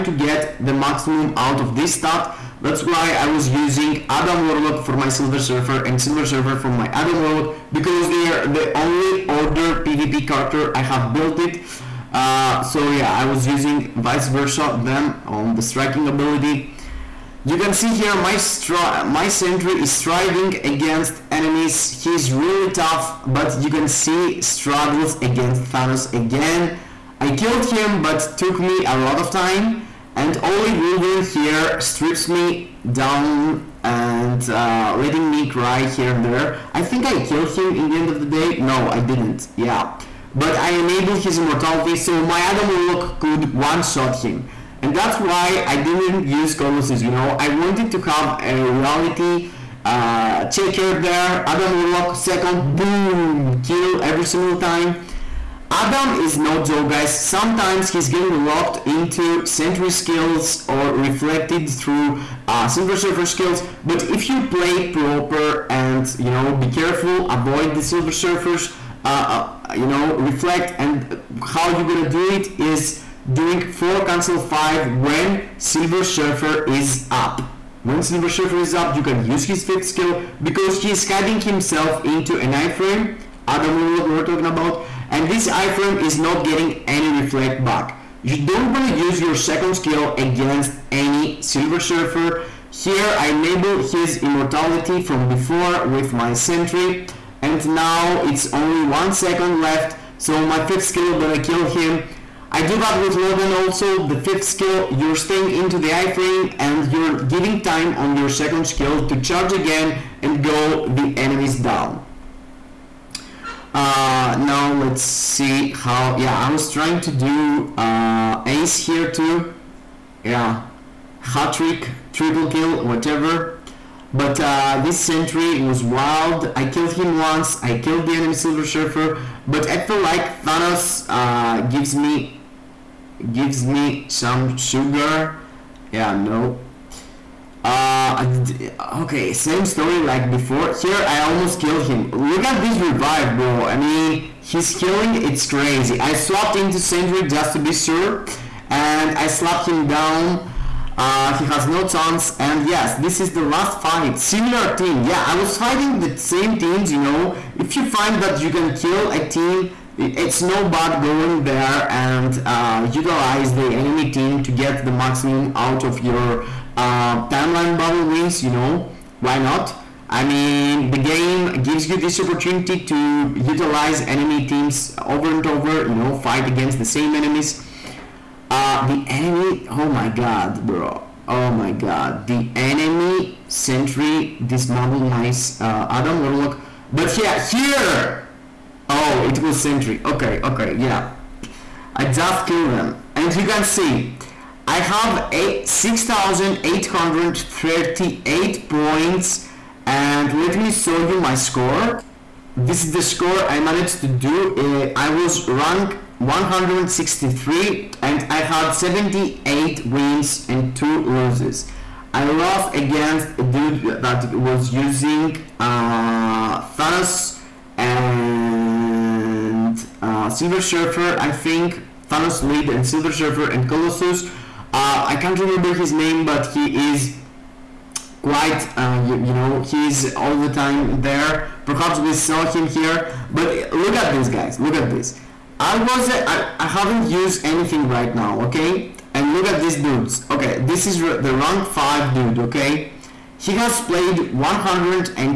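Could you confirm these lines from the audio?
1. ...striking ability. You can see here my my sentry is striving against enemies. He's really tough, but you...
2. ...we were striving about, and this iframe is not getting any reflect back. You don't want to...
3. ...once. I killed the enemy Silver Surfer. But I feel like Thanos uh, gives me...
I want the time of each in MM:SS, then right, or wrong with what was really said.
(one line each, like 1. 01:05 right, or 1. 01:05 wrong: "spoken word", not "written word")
1. 00:15 right
2. 01:24 wrong: "talking", not "striving"
3. 02:07 right.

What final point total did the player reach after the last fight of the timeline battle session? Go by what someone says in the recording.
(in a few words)
6,838.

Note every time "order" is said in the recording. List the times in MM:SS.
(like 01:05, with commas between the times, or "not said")
00:09.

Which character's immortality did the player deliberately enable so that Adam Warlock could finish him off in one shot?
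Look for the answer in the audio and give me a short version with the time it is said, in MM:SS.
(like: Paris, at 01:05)
Wolverine, at 00:30.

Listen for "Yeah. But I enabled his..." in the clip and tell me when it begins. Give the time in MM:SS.
00:39.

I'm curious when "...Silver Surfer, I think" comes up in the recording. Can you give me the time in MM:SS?
03:40.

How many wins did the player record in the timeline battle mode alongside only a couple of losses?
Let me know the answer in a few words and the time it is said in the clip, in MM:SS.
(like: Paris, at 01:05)
78, at 03:28.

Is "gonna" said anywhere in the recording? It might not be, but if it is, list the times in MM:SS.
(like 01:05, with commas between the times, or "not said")
01:11, 01:41.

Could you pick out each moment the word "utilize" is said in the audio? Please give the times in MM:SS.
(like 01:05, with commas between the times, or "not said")
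02:42, 02:53.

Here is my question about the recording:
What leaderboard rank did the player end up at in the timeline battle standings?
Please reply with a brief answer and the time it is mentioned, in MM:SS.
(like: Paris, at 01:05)
163, at 03:26.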